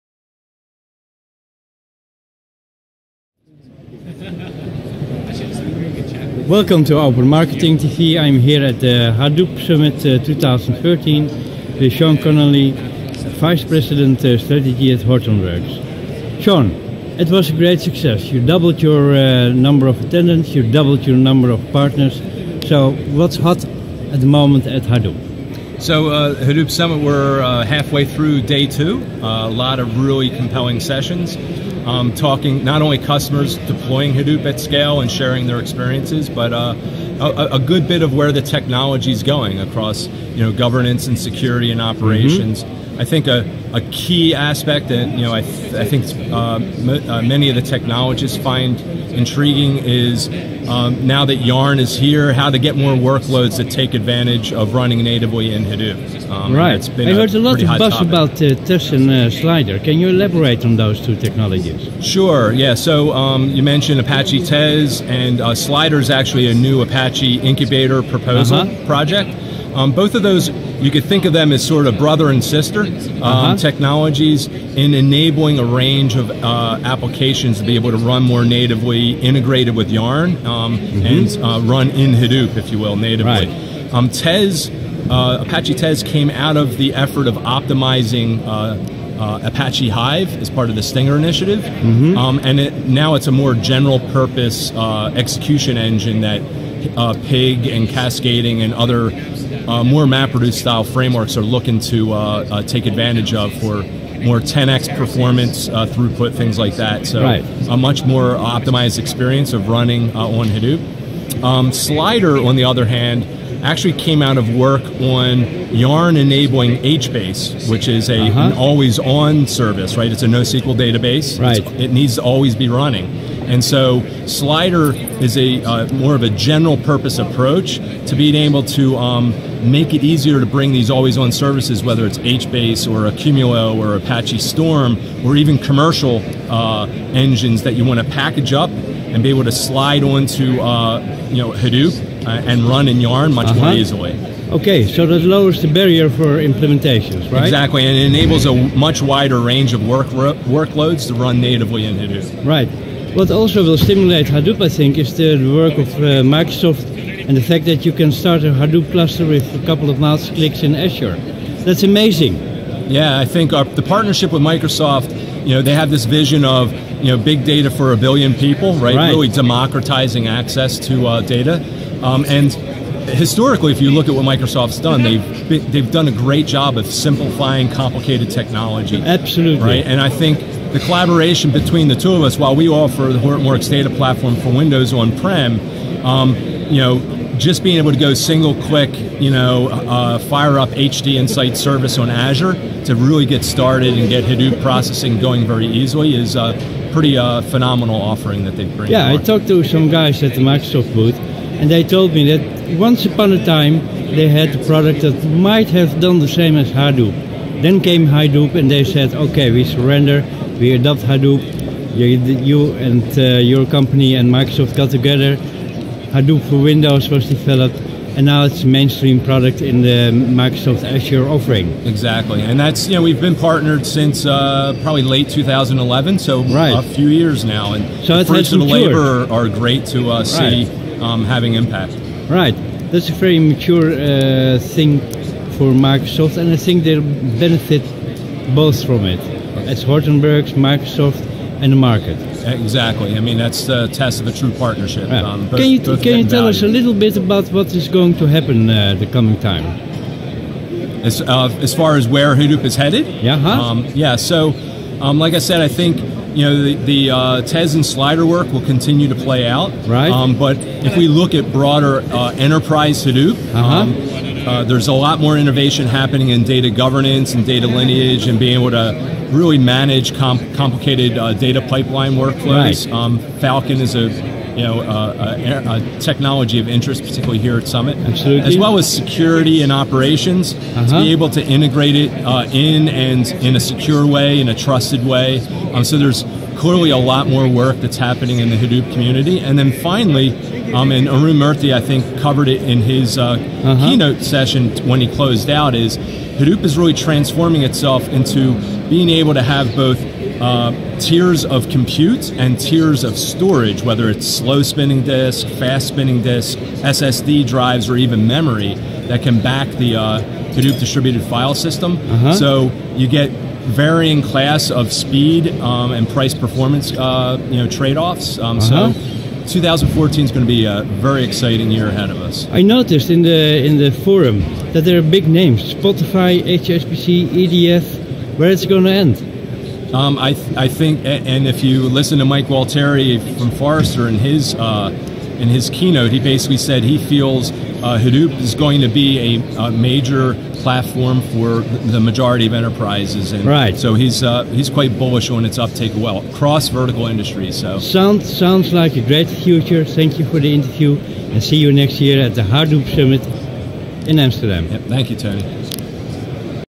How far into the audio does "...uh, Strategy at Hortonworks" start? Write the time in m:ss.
0:14.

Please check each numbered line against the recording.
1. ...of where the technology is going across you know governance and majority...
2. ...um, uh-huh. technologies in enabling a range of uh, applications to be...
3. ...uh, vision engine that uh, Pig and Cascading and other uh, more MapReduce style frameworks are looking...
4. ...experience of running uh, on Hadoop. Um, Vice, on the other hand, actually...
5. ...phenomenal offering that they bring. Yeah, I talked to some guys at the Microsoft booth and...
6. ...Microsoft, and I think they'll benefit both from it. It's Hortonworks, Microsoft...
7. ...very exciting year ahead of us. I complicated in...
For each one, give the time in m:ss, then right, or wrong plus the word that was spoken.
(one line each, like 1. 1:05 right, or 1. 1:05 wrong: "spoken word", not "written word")
1. 0:38 wrong: "security", not "majority"
2. 1:12 right
3. 1:34 wrong: "execution", not "vision"
4. 1:48 wrong: "Slider", not "Vice"
5. 3:17 right
6. 3:55 right
7. 5:21 wrong: "noticed", not "complicated".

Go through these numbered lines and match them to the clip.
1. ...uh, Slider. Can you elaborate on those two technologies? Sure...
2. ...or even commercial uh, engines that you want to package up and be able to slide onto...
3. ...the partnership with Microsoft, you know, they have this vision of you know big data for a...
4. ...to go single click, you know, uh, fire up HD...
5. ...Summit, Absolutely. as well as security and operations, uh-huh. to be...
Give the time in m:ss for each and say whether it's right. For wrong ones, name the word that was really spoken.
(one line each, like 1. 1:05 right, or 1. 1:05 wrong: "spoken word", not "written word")
1. 0:59 right
2. 2:15 right
3. 2:43 right
4. 3:07 right
5. 4:37 right.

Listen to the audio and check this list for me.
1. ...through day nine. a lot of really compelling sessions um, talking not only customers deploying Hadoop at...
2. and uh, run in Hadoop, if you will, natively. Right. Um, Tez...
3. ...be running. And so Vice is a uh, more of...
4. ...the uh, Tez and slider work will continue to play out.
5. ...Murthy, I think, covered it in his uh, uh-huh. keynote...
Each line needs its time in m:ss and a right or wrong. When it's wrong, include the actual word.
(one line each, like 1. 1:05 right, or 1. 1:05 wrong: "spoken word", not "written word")
1. 0:28 wrong: "two", not "nine"
2. 1:21 right
3. 2:02 wrong: "Slider", not "Vice"
4. 4:16 right
5. 4:51 right.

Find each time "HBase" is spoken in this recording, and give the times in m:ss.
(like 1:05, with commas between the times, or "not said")
1:56, 2:12.